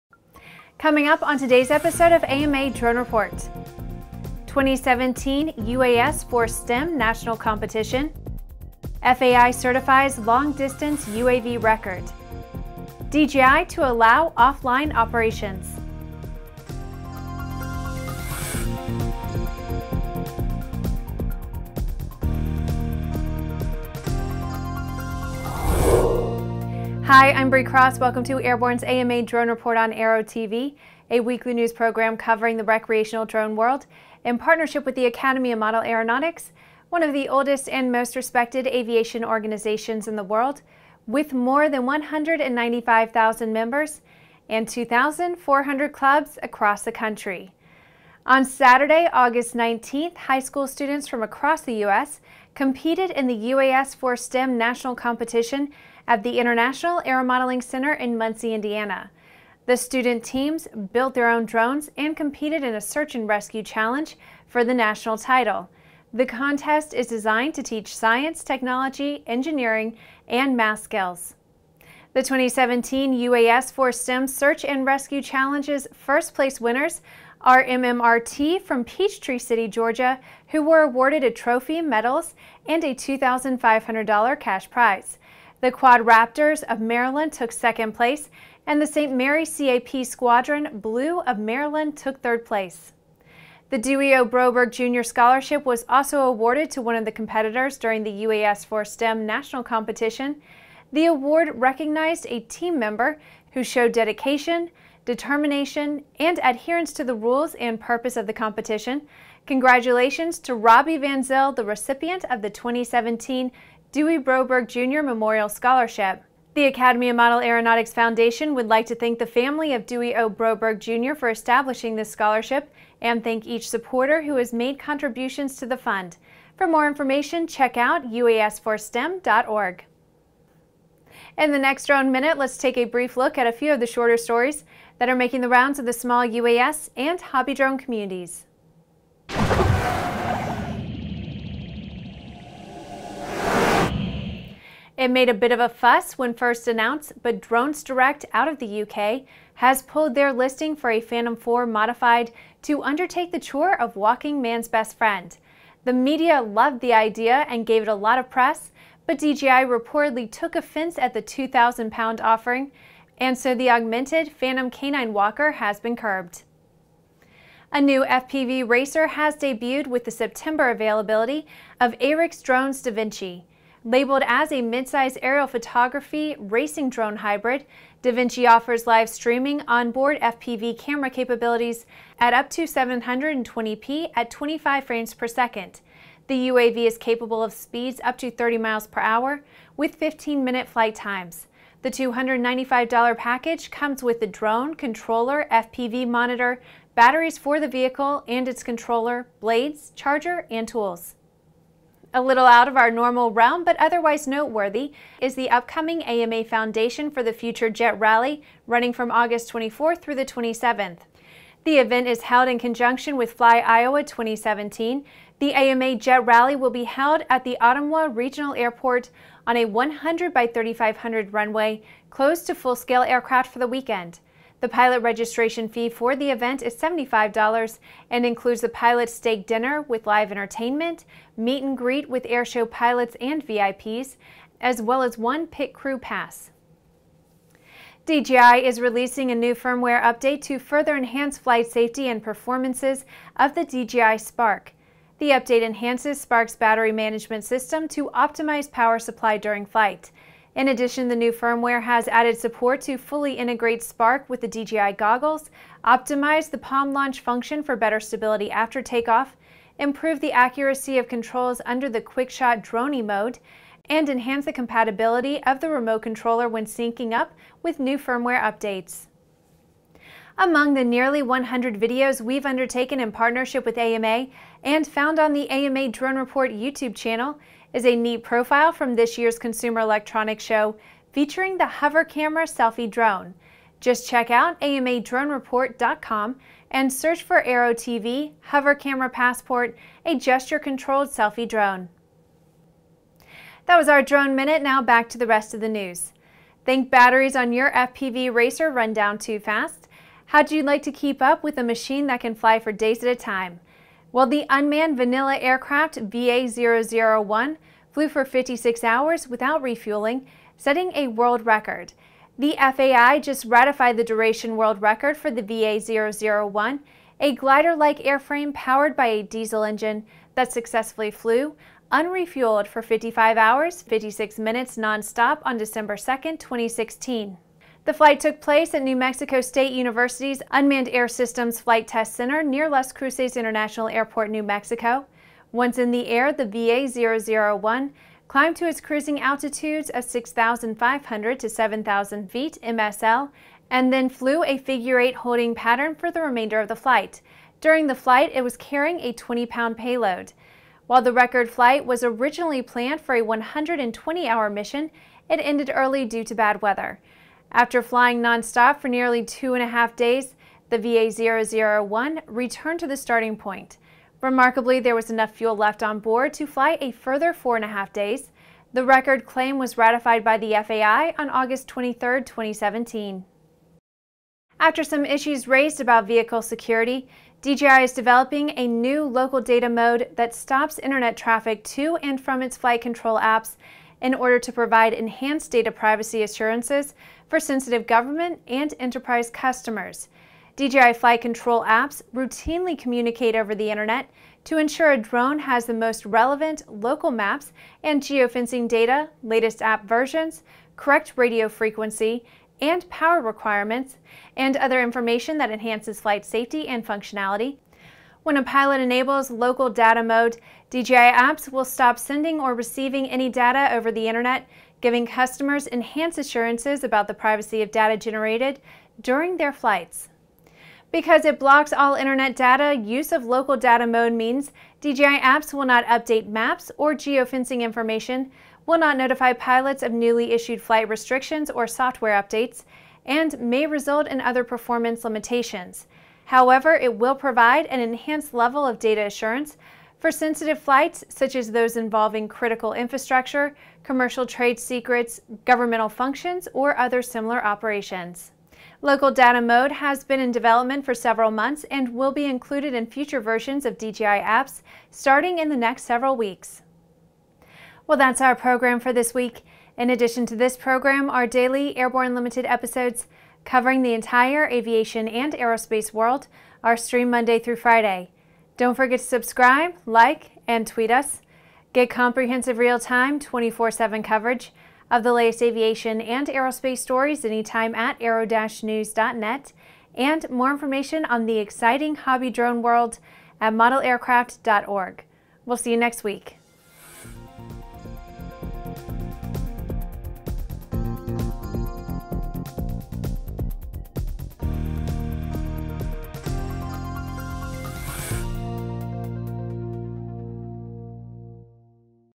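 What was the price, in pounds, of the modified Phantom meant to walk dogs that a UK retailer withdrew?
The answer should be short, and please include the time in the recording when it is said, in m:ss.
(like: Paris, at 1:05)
2,000 pounds, at 2:41.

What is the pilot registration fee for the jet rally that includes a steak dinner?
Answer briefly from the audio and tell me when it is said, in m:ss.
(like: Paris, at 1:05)
$75, at 3:46.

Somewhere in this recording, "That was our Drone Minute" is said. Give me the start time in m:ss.
4:53.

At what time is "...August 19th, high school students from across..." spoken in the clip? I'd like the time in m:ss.
0:49.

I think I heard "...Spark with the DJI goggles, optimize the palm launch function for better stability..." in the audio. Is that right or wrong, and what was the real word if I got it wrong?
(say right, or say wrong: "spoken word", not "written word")
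right.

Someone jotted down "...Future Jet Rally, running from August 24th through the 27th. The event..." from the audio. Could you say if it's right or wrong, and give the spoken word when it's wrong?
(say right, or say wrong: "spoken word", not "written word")
right.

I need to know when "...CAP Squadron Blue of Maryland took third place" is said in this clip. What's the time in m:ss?
1:29.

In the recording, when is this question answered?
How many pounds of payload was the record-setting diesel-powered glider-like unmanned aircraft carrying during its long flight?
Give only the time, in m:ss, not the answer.
5:49.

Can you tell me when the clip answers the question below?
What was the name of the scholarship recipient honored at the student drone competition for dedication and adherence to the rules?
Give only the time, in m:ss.
1:50.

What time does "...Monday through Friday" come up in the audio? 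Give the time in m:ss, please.
7:47.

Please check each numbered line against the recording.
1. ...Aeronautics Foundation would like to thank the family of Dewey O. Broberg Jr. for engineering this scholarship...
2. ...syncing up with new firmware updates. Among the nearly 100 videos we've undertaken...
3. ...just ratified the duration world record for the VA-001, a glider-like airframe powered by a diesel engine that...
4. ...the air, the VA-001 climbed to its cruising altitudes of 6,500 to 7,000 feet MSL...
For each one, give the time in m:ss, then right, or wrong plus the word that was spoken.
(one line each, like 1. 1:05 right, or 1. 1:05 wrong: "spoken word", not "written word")
1. 1:57 wrong: "establishing", not "engineering"
2. 4:26 right
3. 5:13 right
4. 5:35 right.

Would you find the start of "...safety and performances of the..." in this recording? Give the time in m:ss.
4:01.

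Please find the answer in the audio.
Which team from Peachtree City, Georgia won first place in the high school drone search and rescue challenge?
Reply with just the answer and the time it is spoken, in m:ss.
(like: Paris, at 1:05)
MMRT, at 1:17.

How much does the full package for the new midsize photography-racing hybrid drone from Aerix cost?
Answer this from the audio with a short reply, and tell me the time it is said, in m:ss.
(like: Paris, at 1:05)
$295, at 3:11.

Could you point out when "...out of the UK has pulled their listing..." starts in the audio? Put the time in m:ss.
2:28.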